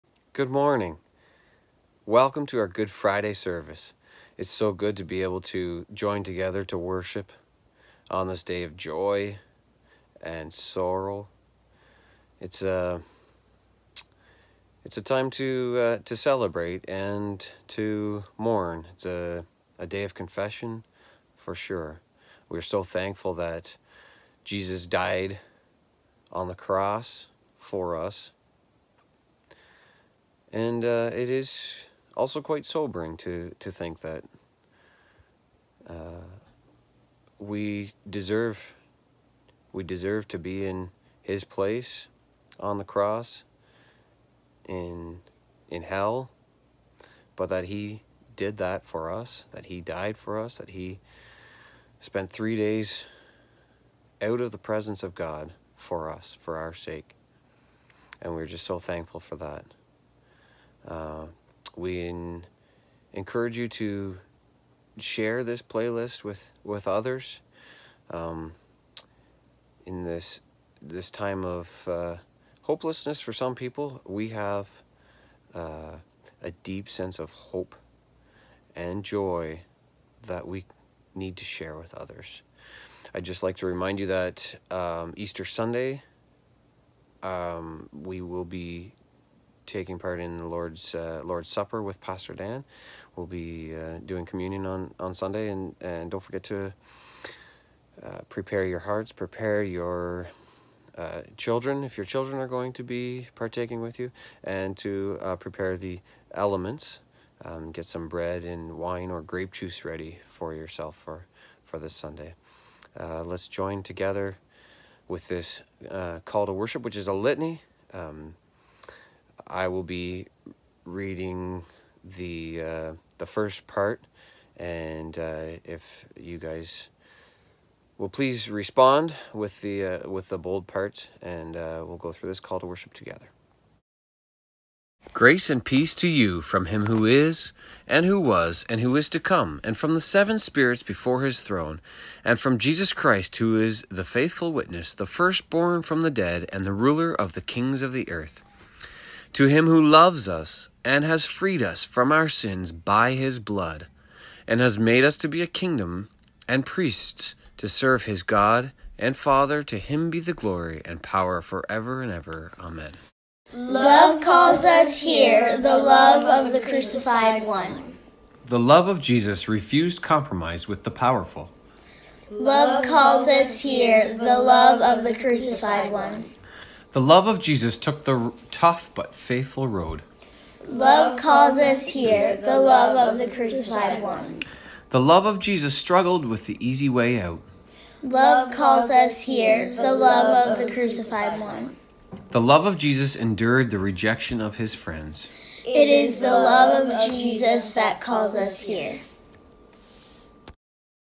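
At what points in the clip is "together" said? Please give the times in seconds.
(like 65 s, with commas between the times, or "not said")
6 s, 113 s, 132 s.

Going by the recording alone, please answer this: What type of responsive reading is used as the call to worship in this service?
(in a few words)
A litany.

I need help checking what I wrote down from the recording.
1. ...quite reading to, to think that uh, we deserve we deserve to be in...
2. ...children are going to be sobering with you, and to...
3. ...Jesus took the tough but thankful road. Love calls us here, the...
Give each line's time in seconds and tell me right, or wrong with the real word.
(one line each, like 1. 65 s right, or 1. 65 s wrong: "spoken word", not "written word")
1. 32 s wrong: "sobering", not "reading"
2. 102 s wrong: "partaking", not "sobering"
3. 177 s wrong: "faithful", not "thankful".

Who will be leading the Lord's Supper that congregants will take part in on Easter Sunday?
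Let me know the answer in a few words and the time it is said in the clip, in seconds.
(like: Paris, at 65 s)
Pastor Dan, at 92 s.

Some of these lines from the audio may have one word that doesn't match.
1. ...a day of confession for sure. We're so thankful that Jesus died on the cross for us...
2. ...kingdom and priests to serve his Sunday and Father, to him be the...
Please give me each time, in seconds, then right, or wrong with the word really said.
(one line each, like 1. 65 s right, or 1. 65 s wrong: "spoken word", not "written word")
1. 19 s right
2. 155 s wrong: "God", not "Sunday".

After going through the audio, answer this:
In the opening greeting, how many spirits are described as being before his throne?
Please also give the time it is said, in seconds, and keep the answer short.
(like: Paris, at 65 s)
7, at 139 s.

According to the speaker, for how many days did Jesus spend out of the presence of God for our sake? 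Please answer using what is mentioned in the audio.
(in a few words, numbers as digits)
3.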